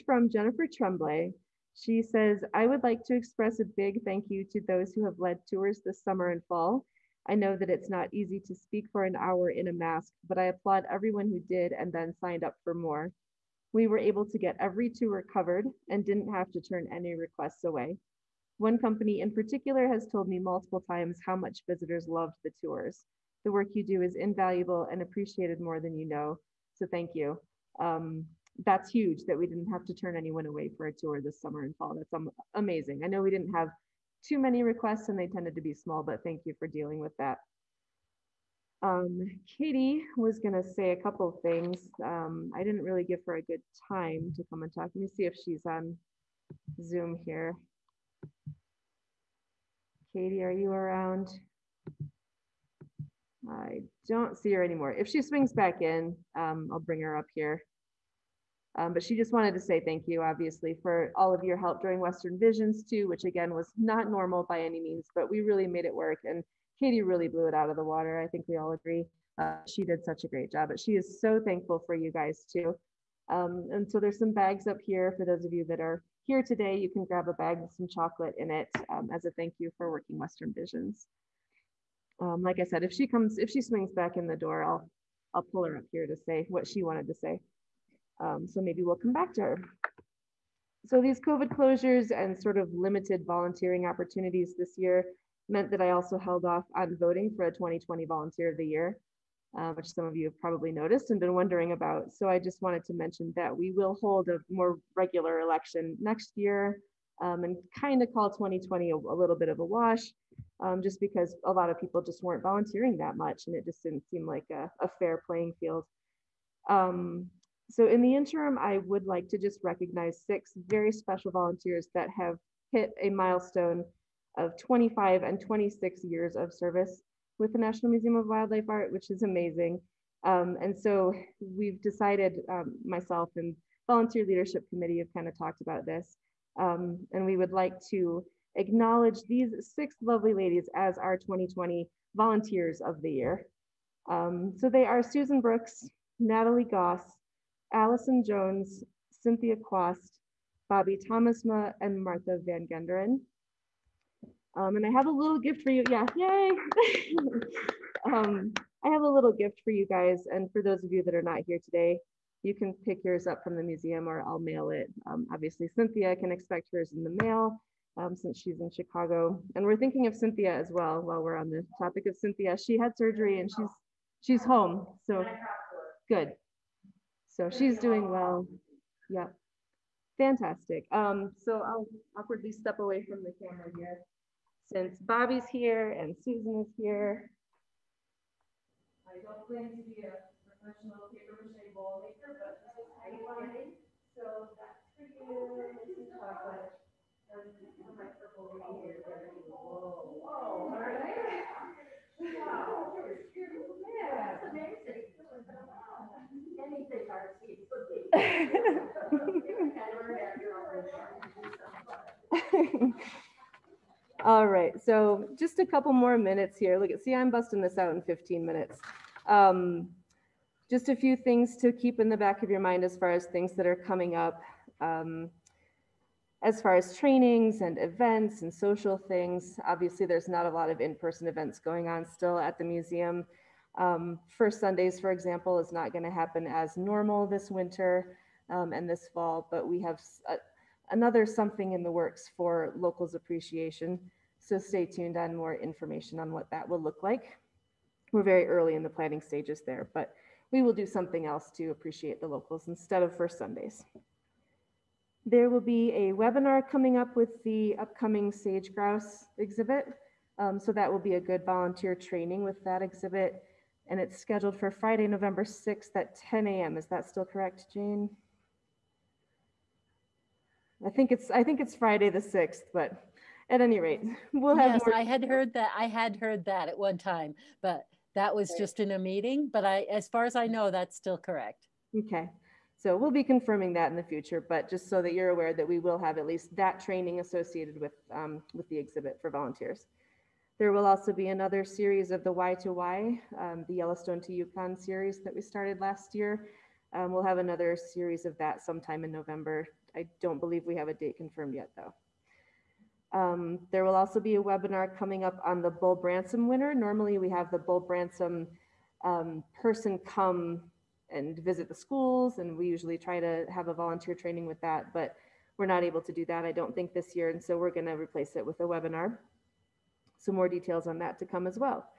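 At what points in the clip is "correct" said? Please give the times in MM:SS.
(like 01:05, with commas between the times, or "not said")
04:27, 04:41.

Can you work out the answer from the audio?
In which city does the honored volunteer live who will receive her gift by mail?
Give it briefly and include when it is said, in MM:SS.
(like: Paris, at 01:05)
Chicago, at 02:48.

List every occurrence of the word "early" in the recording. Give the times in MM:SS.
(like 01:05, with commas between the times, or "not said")
04:08.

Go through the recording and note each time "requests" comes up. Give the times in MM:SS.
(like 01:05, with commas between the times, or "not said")
00:17, 00:34.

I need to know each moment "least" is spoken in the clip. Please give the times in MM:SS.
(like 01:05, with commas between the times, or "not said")
04:46.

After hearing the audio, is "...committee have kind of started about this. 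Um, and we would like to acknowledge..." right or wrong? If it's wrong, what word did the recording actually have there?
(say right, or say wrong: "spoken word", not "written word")
wrong: "talked", not "started".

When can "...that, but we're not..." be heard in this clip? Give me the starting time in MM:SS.
05:14.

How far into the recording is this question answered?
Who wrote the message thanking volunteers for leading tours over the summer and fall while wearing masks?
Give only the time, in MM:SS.
00:00.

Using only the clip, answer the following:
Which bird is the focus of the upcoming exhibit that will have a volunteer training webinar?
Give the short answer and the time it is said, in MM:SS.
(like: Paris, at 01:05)
Sage grouse, at 04:18.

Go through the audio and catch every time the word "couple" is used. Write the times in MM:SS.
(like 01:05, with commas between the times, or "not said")
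00:40, 03:35.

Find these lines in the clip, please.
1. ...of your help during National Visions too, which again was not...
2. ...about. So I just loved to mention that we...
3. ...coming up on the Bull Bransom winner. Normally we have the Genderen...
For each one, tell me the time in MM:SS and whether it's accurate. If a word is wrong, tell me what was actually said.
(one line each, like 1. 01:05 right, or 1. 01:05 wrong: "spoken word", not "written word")
1. 01:01 wrong: "Western", not "National"
2. 01:41 wrong: "wanted", not "loved"
3. 05:04 wrong: "Bull", not "Genderen".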